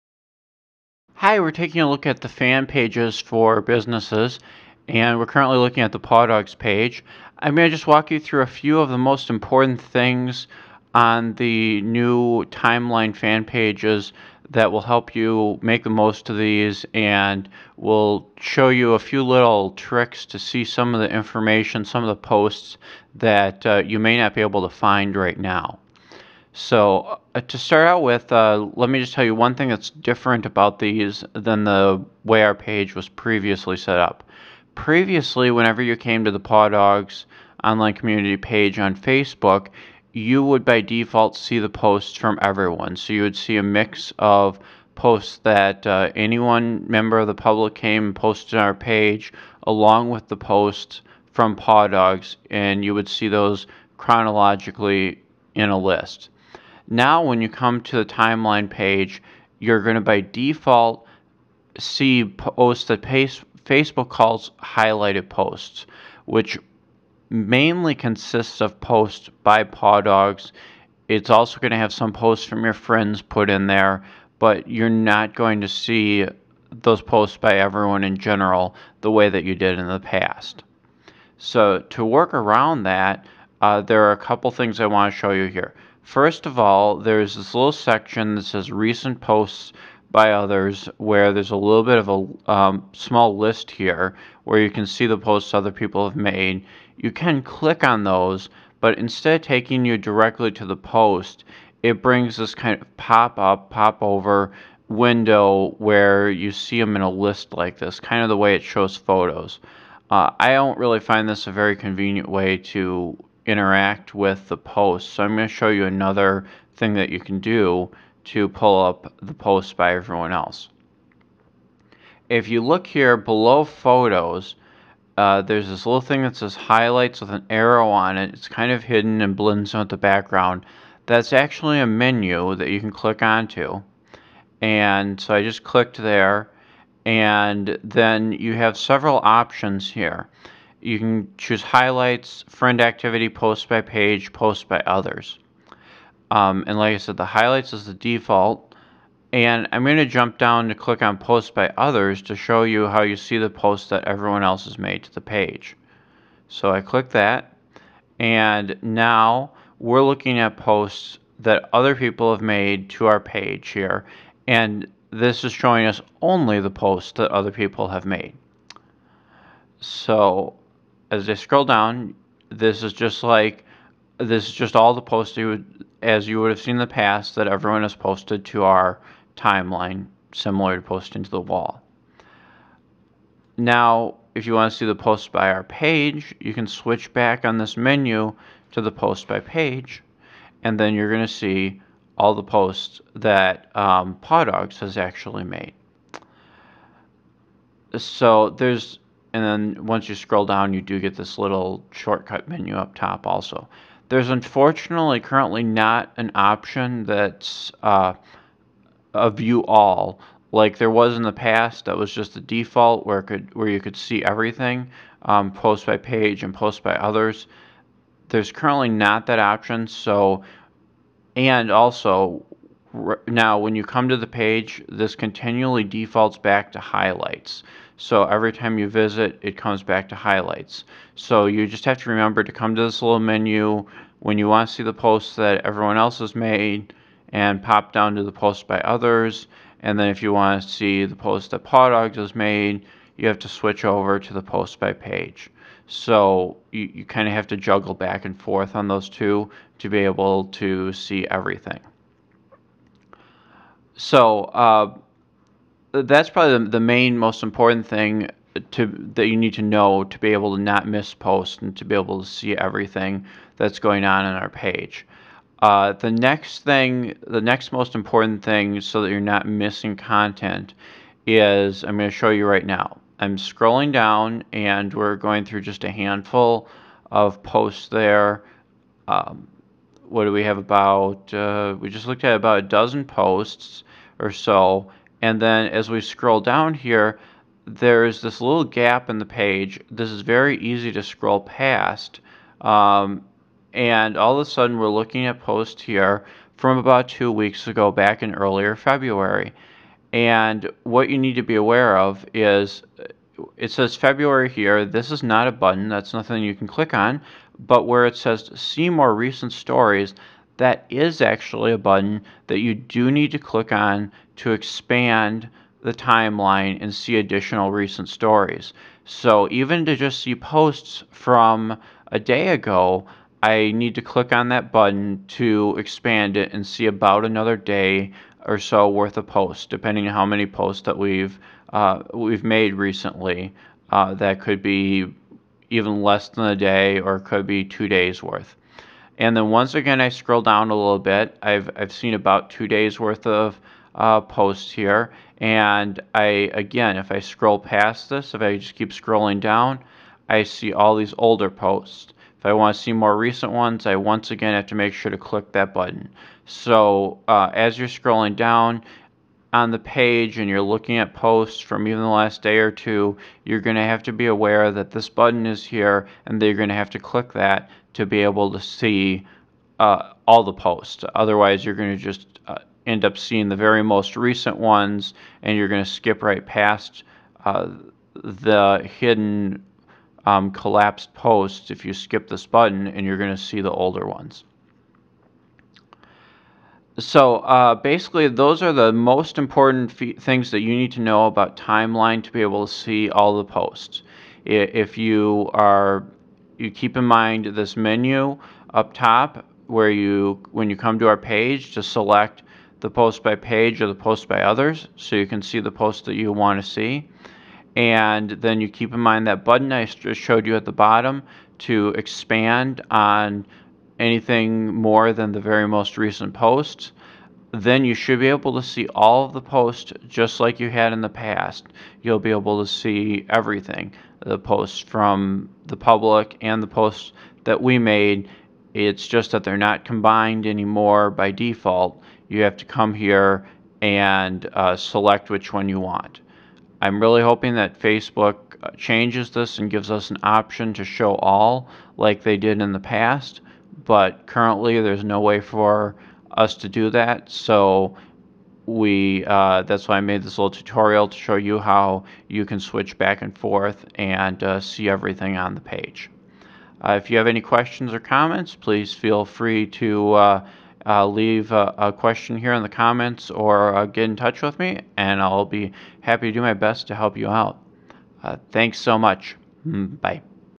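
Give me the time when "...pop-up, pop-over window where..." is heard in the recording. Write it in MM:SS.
01:42.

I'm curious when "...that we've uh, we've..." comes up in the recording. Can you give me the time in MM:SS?
05:30.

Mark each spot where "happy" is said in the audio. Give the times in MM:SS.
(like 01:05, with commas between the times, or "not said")
07:45.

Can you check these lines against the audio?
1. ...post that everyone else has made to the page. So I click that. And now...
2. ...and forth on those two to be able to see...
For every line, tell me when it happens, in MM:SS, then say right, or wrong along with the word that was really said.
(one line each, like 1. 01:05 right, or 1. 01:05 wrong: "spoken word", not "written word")
1. 02:33 right
2. 04:08 right.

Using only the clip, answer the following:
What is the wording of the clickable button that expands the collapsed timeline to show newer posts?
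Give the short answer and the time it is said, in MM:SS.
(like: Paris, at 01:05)
see more recent stories, at 05:08.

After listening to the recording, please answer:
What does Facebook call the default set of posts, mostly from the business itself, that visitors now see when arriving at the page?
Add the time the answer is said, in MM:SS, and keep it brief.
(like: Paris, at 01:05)
highlighted posts, at 01:04.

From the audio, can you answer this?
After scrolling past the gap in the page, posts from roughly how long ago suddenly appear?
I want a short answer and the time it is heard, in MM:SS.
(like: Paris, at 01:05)
two weeks ago, at 04:57.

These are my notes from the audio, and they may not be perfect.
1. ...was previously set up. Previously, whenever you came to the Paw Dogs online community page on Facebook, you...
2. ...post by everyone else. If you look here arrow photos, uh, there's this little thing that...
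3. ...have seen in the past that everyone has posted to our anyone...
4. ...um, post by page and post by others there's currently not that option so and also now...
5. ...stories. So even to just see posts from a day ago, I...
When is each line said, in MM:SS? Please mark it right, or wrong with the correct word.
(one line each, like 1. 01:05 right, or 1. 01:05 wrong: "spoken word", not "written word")
1. 00:32 right
2. 01:59 wrong: "below", not "arrow"
3. 02:56 wrong: "timeline", not "anyone"
4. 03:35 right
5. 05:18 right.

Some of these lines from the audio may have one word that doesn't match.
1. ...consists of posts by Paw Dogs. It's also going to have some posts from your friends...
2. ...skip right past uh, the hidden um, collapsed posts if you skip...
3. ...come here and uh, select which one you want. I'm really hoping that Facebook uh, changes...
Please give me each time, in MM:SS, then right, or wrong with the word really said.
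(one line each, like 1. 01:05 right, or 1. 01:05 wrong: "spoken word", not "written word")
1. 01:07 right
2. 06:15 right
3. 07:12 right.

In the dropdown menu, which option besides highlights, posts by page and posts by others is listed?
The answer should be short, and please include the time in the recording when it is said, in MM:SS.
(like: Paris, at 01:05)
friend activity, at 02:22.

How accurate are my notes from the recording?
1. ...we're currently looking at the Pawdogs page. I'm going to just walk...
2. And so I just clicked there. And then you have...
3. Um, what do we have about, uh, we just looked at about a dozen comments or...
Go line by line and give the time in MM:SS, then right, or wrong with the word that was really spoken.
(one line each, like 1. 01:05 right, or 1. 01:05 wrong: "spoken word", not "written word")
1. 00:05 right
2. 02:14 right
3. 04:39 wrong: "posts", not "comments".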